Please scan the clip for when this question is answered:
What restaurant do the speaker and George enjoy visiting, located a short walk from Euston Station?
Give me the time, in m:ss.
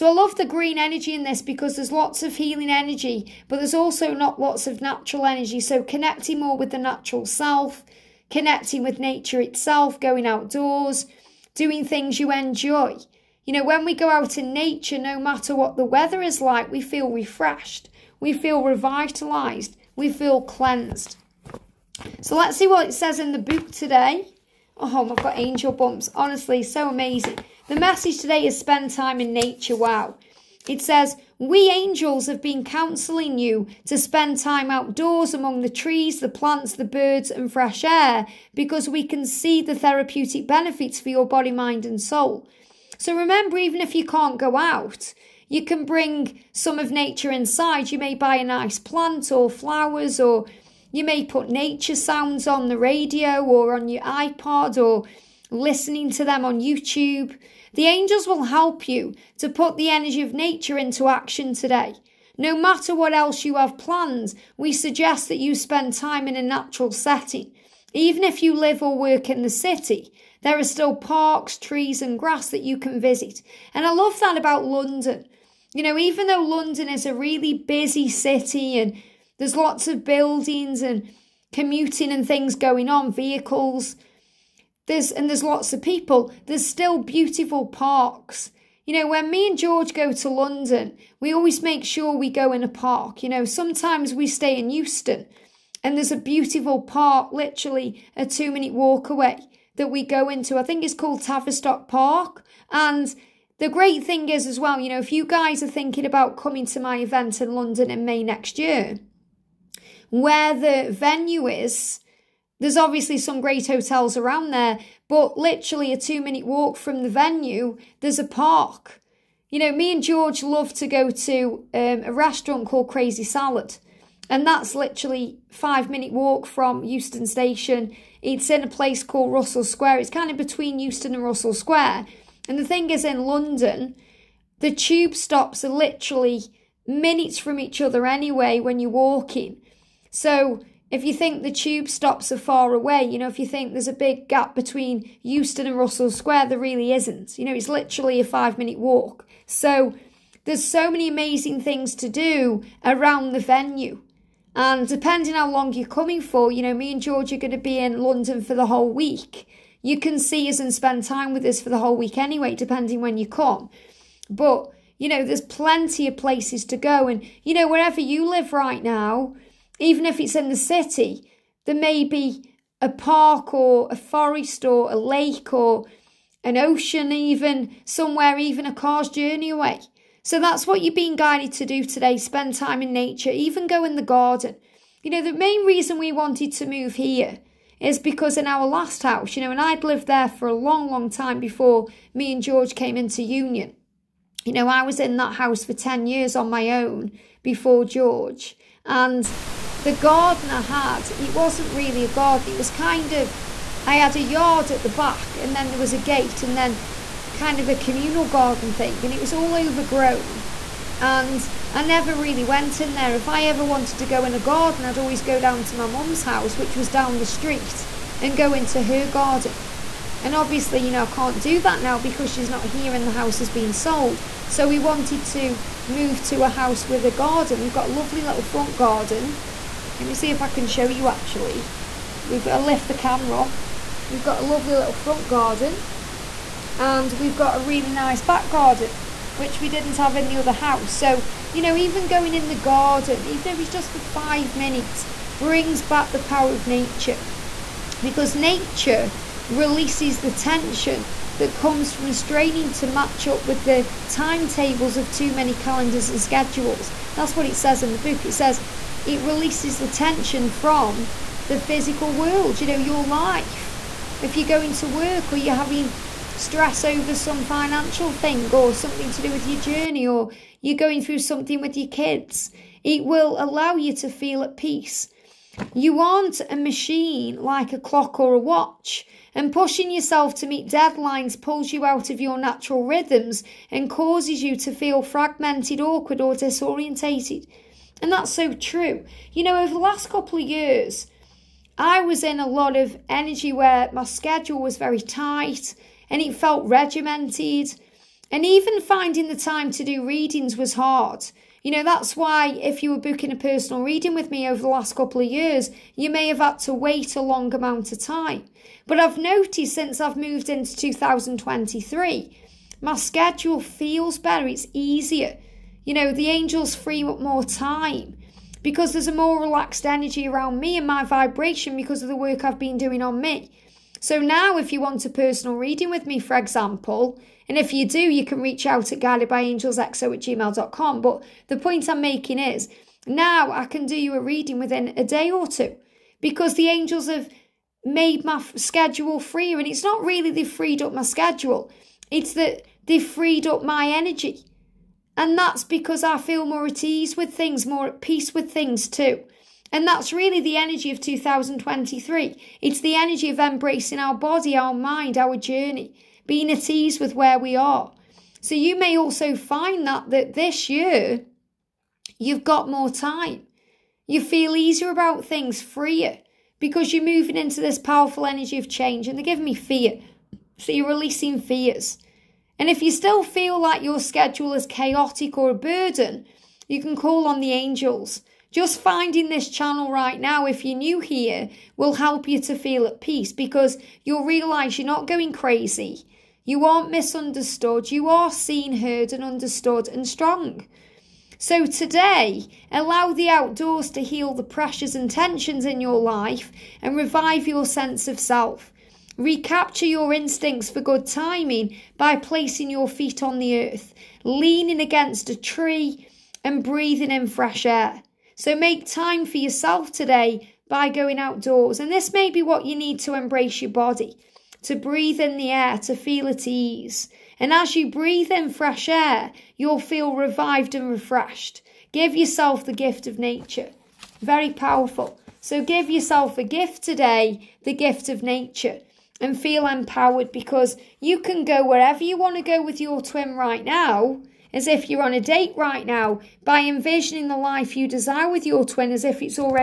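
2:02.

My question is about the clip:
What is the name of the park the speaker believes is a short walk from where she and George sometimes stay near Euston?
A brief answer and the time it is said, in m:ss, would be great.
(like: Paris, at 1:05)
Tavistock Park, at 1:41.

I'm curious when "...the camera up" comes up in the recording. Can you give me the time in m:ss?
3:52.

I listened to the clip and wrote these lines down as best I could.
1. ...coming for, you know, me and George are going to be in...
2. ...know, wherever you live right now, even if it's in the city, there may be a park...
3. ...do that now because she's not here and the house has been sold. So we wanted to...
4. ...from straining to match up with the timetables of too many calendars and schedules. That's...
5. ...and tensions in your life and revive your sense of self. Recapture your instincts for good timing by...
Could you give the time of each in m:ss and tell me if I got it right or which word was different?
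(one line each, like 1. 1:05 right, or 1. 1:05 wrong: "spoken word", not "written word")
1. 2:35 right
2. 2:47 right
3. 3:41 right
4. 4:11 right
5. 6:34 right.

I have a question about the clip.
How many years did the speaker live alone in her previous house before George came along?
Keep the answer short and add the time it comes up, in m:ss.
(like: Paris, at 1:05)
10, at 3:15.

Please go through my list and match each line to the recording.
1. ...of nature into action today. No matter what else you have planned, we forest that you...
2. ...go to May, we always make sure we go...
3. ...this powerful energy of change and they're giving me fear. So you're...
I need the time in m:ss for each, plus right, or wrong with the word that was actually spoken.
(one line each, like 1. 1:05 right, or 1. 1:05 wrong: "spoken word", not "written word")
1. 1:00 wrong: "suggest", not "forest"
2. 1:29 wrong: "London", not "May"
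3. 6:07 right.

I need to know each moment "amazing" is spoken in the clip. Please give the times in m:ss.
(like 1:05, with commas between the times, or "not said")
0:26, 2:31.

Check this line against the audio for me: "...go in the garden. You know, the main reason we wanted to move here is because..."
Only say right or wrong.
right.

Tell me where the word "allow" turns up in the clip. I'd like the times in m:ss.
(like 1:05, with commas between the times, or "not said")
4:33, 6:32.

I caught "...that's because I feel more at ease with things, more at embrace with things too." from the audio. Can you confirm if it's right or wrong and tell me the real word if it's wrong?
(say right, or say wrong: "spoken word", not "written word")
wrong: "peace", not "embrace".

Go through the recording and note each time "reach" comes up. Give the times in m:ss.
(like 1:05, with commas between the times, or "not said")
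5:28.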